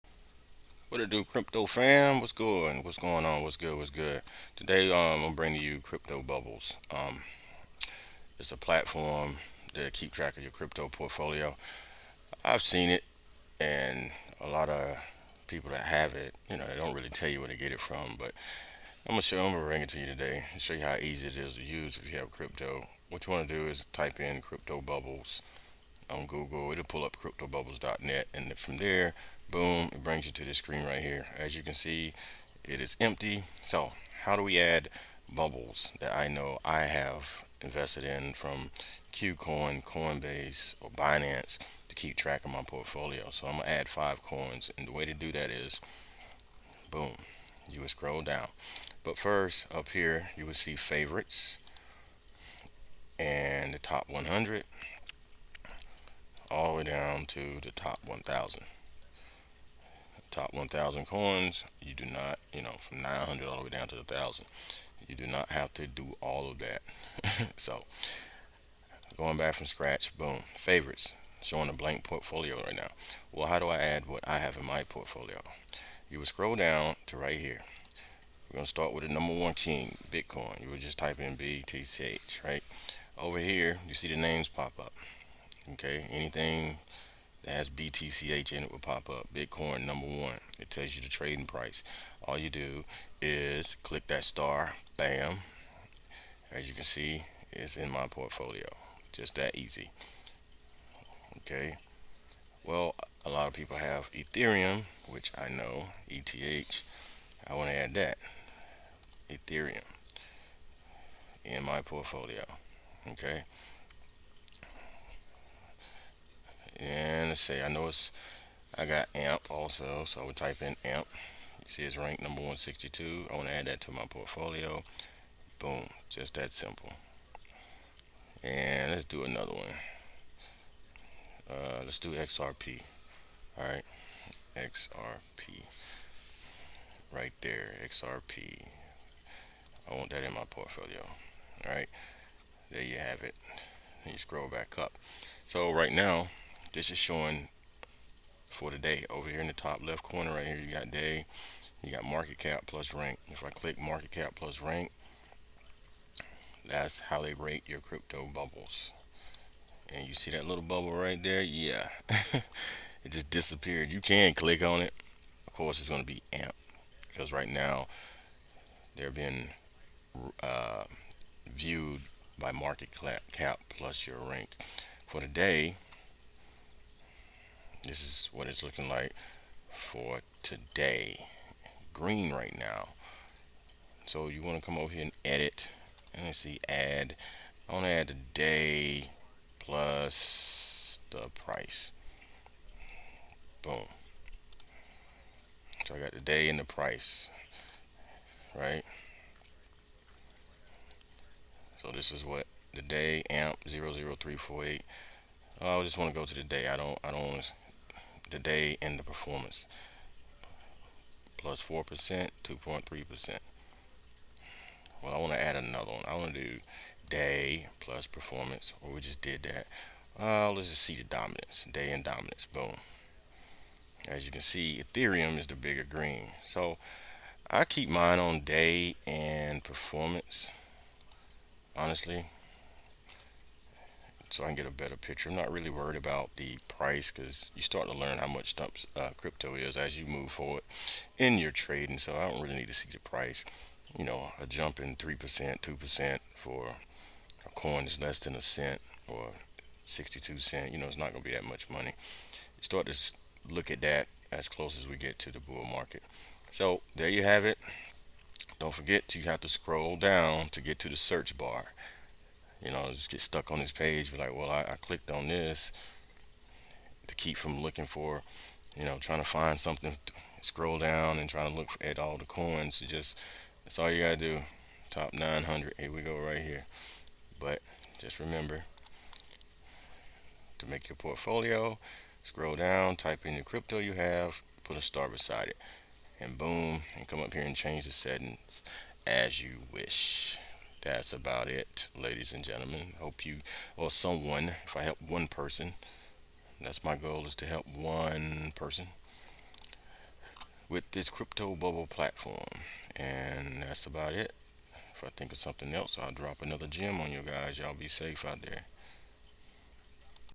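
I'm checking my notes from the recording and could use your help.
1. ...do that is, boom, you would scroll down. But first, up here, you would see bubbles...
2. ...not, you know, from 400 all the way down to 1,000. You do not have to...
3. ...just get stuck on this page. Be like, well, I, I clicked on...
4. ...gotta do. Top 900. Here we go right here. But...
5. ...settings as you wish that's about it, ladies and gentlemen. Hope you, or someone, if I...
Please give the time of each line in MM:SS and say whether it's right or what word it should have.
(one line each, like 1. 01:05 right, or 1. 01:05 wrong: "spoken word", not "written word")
1. 00:45 wrong: "favorites", not "bubbles"
2. 01:02 wrong: "900", not "400"
3. 04:22 right
4. 04:34 right
5. 04:47 right.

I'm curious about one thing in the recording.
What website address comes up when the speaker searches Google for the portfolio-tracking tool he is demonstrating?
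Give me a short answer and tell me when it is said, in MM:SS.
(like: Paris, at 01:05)
cryptobubbles.net, at 00:27.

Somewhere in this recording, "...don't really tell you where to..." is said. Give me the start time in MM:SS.
00:16.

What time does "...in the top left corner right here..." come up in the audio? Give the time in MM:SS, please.
02:29.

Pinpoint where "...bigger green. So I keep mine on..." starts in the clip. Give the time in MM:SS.
03:45.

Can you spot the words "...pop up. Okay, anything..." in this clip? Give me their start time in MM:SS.
01:24.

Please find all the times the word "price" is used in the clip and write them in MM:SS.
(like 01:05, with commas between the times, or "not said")
01:31, 03:11, 03:16, 03:56, 04:02.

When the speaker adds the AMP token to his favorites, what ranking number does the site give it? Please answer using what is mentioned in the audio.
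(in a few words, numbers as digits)
162.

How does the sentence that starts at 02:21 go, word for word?
All right, there you have it.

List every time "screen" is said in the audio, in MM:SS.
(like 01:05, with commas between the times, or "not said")
00:30.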